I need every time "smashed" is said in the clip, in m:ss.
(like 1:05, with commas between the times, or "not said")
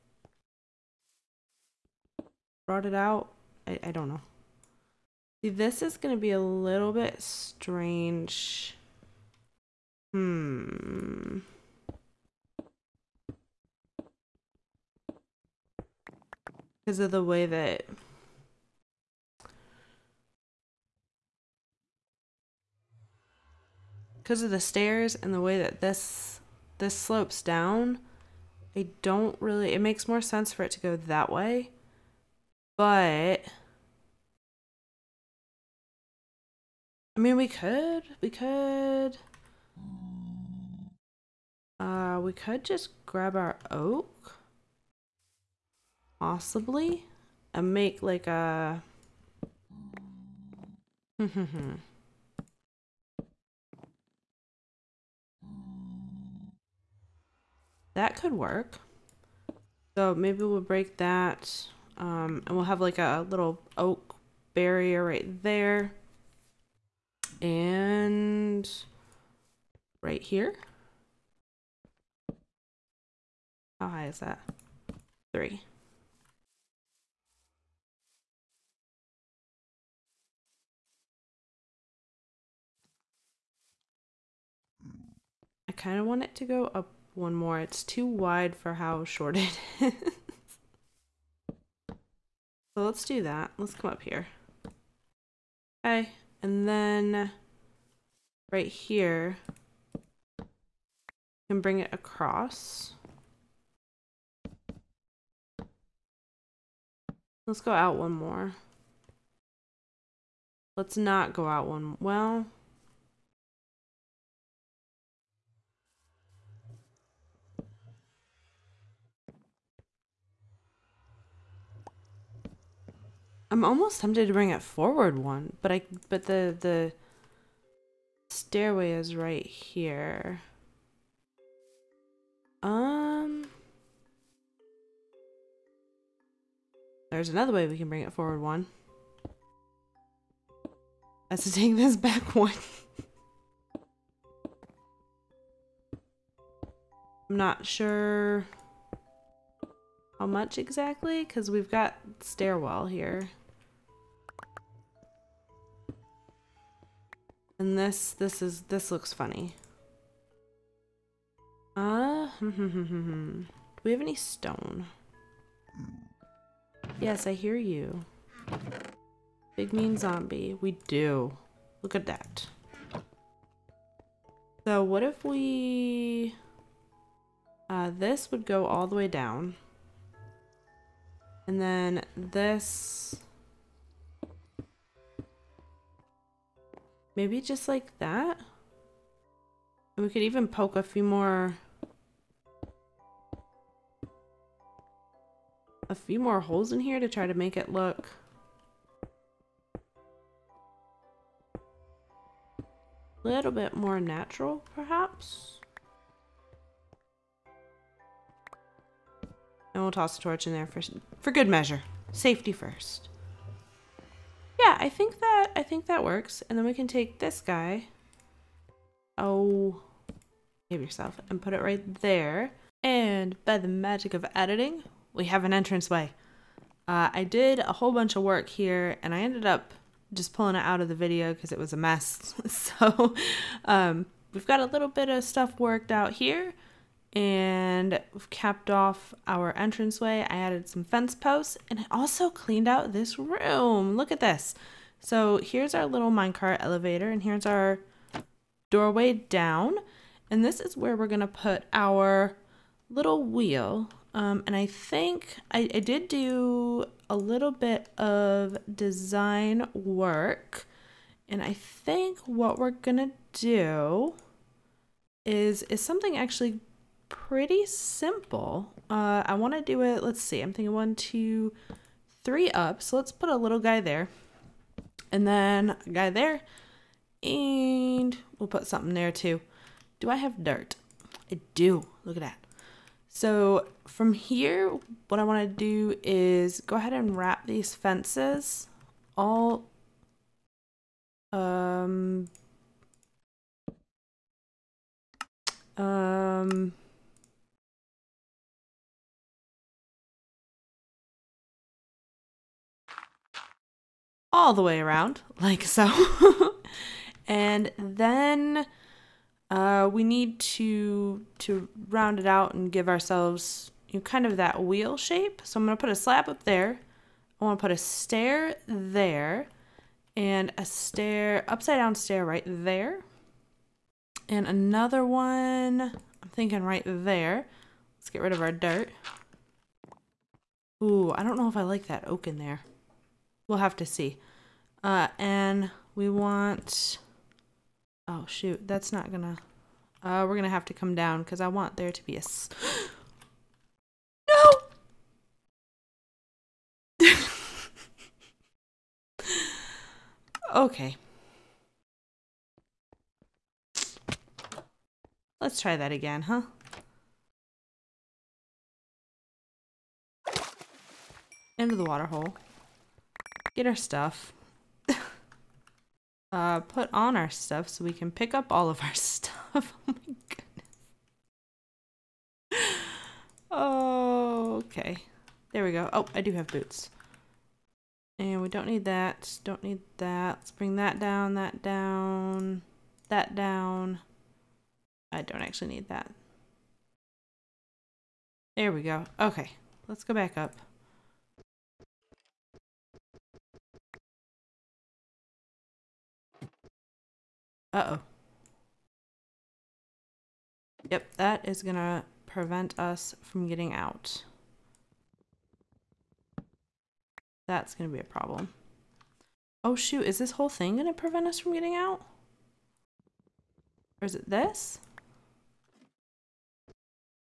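not said.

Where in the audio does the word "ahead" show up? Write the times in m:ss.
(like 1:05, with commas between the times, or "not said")
4:46.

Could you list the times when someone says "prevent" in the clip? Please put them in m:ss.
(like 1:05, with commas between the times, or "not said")
6:42, 6:50.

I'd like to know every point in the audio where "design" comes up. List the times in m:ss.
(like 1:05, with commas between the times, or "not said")
4:18.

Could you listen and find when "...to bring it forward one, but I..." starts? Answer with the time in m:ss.
2:04.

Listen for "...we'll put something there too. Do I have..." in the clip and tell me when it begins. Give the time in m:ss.
4:38.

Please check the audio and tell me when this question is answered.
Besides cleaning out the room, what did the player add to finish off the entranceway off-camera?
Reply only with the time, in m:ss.
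4:00.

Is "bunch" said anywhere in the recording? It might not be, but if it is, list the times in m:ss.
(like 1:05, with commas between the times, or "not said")
3:47.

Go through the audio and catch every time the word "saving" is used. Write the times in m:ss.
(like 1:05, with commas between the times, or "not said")
not said.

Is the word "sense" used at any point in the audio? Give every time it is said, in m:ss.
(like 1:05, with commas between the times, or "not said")
0:30.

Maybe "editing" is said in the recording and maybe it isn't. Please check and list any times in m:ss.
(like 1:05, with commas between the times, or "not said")
3:44.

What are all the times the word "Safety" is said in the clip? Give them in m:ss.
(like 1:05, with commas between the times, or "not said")
3:32.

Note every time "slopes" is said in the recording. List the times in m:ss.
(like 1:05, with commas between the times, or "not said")
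0:26.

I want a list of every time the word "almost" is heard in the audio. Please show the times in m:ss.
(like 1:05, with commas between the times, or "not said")
2:03.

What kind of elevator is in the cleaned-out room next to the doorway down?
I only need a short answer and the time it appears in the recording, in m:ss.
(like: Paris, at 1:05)
minecart elevator, at 4:06.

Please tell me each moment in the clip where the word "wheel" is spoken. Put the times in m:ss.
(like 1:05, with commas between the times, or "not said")
4:13, 5:14.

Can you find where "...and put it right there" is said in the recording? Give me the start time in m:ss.
3:41.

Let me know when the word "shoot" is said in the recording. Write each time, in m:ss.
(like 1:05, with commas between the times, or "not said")
5:38, 6:49.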